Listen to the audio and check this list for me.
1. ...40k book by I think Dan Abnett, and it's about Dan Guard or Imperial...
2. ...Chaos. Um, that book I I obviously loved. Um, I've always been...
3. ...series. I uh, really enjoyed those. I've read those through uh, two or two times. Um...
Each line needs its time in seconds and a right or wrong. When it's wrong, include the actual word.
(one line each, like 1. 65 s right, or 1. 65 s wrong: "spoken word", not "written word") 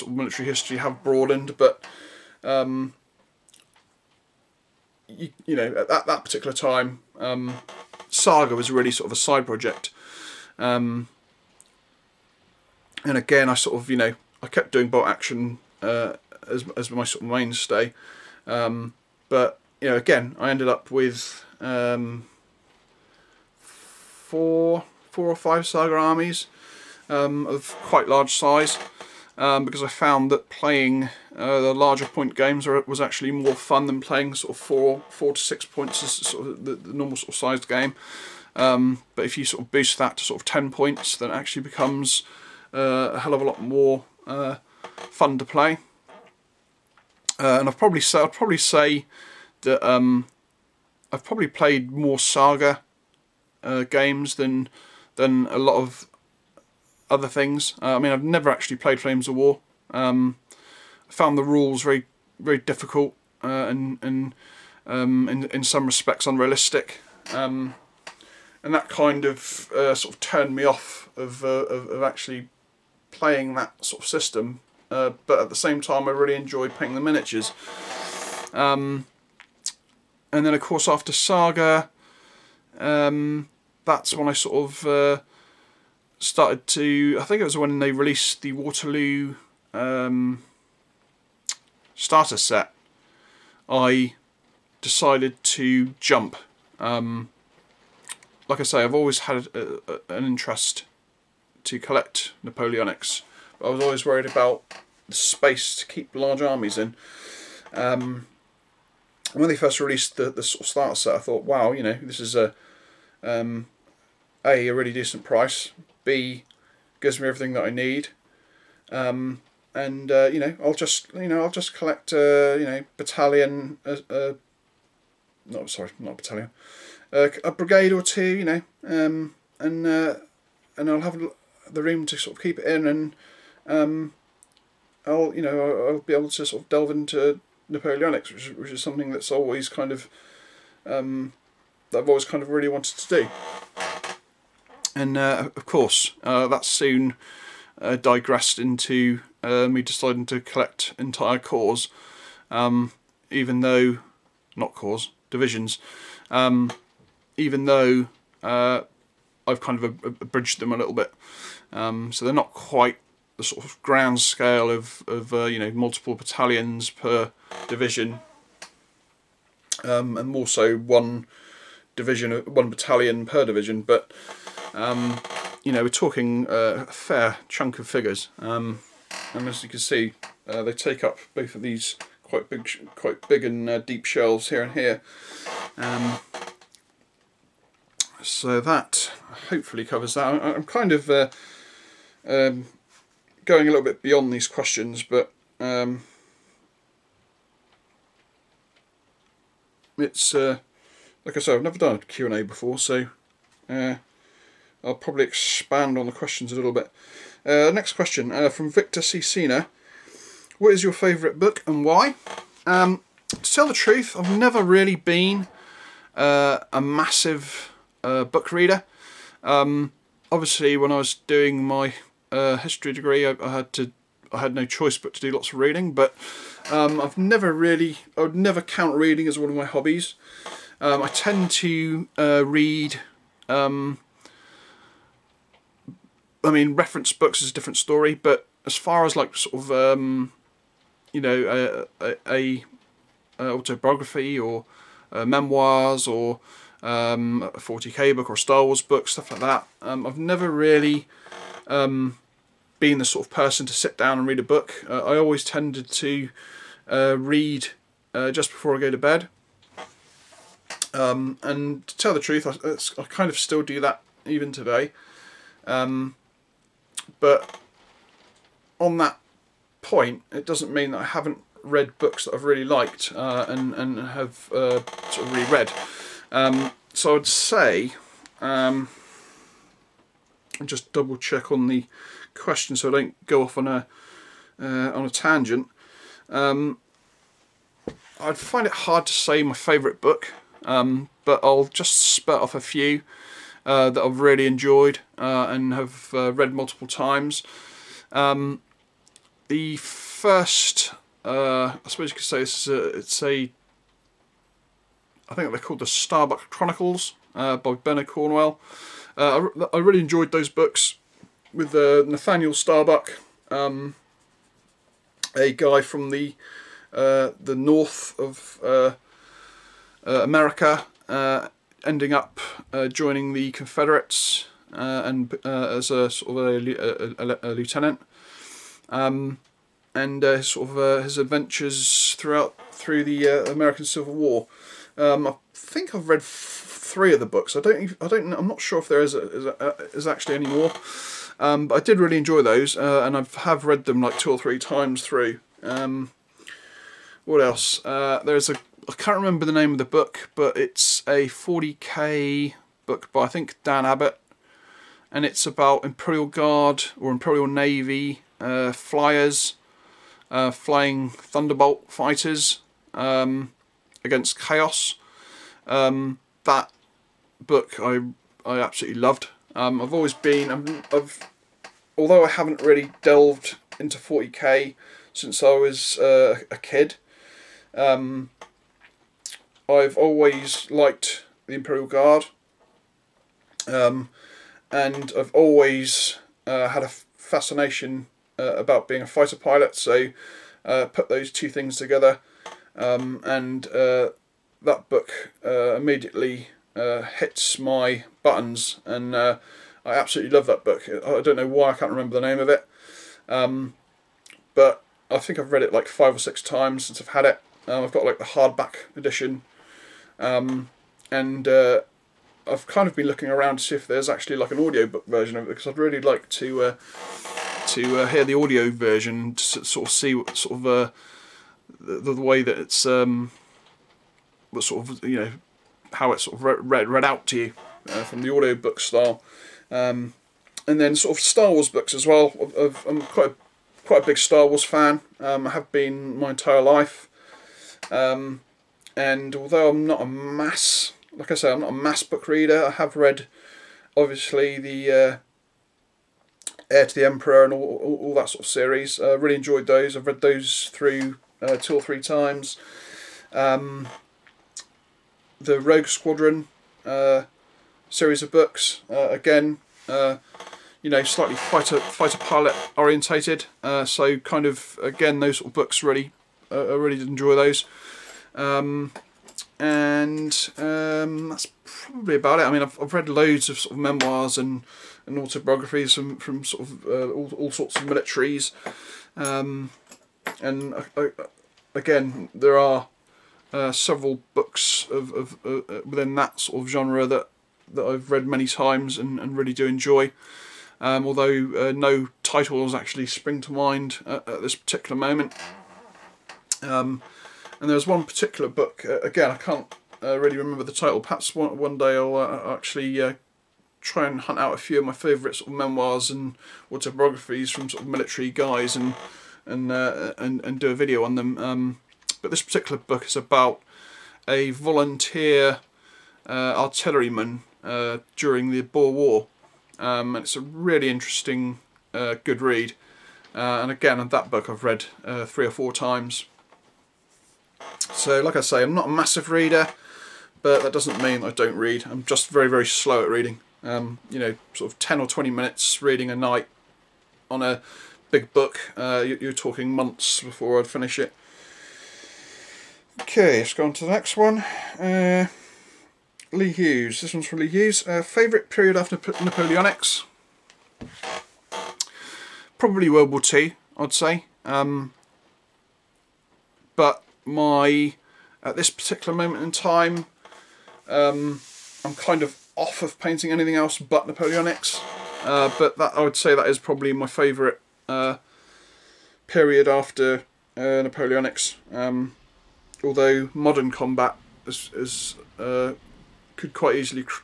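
1. 351 s wrong: "Imperial", not "Dan"
2. 364 s wrong: "absolutely", not "obviously"
3. 448 s wrong: "three", not "two".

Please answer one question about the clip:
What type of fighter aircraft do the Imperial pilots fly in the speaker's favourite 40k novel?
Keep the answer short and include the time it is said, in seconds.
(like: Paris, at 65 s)
Thunderbolt, at 361 s.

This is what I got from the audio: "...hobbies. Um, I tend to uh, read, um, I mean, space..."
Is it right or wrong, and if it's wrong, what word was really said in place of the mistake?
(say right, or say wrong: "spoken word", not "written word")
wrong: "reference", not "space".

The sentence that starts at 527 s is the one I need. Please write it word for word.
So, like I say, I'm not a massive reader, but that doesn't mean I don't read.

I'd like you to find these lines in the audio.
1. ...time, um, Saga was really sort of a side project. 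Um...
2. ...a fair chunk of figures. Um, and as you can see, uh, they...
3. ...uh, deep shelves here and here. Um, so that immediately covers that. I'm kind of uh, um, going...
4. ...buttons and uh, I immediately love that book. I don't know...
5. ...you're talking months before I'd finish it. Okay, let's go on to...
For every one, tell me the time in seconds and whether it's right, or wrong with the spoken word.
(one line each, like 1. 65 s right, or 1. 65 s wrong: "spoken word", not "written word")
1. 6 s right
2. 176 s right
3. 183 s wrong: "hopefully", not "immediately"
4. 398 s wrong: "absolutely", not "immediately"
5. 539 s right.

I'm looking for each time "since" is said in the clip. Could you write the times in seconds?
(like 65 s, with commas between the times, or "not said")
375 s, 406 s.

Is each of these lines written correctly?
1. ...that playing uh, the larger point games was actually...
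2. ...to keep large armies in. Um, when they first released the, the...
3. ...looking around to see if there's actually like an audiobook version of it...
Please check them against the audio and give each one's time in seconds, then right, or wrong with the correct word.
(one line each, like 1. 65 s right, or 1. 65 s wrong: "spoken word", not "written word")
1. 30 s right
2. 105 s right
3. 413 s right.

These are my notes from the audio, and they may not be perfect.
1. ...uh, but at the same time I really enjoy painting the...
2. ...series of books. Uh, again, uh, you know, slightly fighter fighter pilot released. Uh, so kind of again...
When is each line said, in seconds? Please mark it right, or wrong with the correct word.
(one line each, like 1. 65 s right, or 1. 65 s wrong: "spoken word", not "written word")
1. 74 s right
2. 457 s wrong: "orientated", not "released".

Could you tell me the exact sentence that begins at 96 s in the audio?
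Um, like I say, I've always had a, a, an interest to collect Napoleonics.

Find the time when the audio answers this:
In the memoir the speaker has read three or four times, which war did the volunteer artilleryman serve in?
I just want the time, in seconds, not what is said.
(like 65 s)
518 s.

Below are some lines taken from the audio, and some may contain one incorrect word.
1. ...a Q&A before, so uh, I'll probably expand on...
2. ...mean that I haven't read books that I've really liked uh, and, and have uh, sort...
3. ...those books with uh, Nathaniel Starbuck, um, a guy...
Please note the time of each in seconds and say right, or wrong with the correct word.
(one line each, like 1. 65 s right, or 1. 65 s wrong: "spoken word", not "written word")
1. 201 s right
2. 270 s right
3. 310 s right.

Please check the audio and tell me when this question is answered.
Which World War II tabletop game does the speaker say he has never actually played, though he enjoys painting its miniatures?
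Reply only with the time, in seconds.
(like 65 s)
58 s.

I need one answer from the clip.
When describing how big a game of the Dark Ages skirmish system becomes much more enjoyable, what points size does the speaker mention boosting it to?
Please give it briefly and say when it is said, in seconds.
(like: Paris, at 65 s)
10 points, at 40 s.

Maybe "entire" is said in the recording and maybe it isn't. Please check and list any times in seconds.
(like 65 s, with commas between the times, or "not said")
150 s, 436 s.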